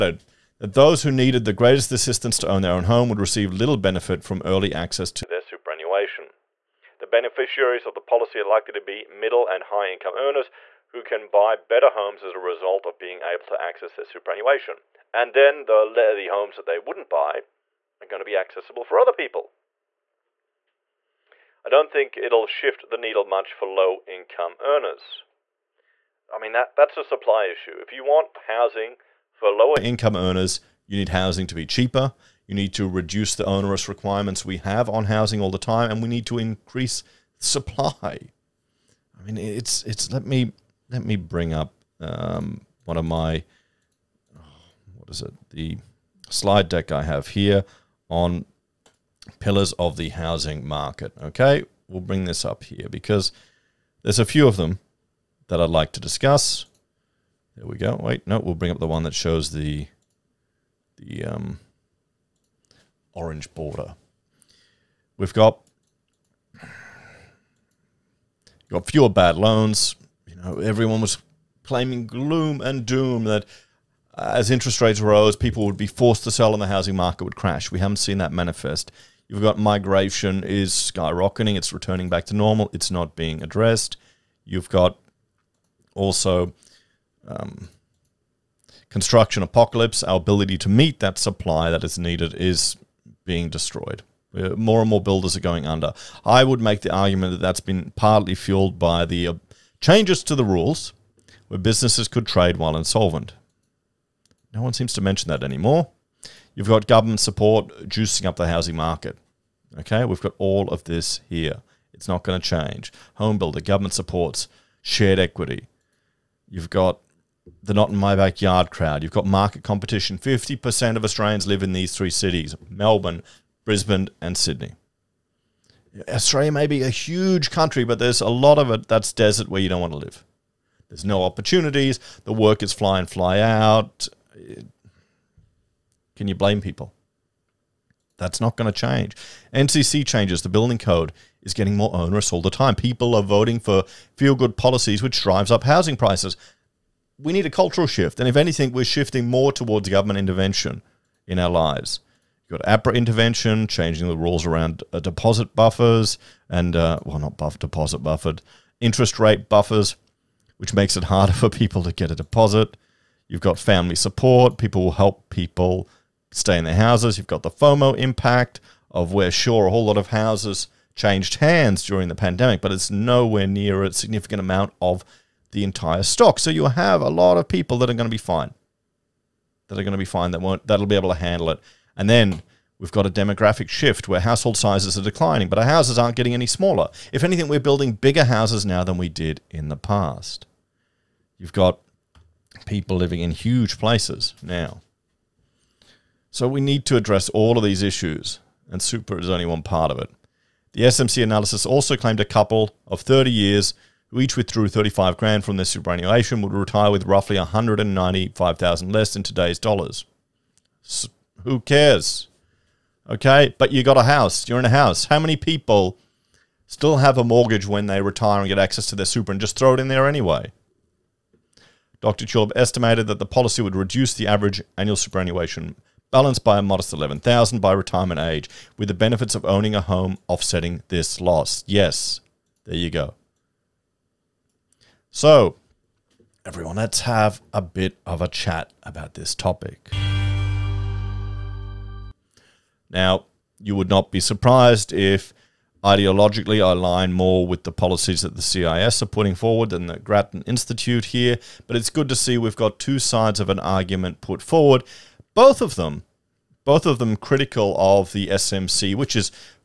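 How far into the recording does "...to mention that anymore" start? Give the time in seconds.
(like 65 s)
104 s.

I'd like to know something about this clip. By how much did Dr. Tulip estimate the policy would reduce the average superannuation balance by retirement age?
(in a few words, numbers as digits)
11,000.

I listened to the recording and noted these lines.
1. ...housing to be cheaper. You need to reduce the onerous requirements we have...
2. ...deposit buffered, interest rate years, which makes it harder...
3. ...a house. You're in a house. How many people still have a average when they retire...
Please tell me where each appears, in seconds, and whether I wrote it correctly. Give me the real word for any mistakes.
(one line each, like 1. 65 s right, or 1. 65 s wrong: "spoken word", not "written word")
1. 31 s right
2. 157 s wrong: "buffers", not "years"
3. 213 s wrong: "mortgage", not "average".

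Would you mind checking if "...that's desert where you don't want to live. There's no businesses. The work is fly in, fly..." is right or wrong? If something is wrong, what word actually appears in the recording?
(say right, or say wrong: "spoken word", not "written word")
wrong: "opportunities", not "businesses".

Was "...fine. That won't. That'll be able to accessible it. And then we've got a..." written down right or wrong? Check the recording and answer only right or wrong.
wrong.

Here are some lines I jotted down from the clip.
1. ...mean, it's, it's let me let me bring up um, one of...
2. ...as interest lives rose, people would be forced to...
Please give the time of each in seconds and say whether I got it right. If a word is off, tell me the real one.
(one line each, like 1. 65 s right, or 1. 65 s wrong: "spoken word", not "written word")
1. 39 s right
2. 74 s wrong: "rates", not "lives".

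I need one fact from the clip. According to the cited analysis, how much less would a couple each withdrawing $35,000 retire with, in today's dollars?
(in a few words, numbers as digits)
195,000.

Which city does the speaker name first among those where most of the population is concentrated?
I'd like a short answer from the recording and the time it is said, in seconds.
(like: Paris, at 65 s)
Melbourne, at 122 s.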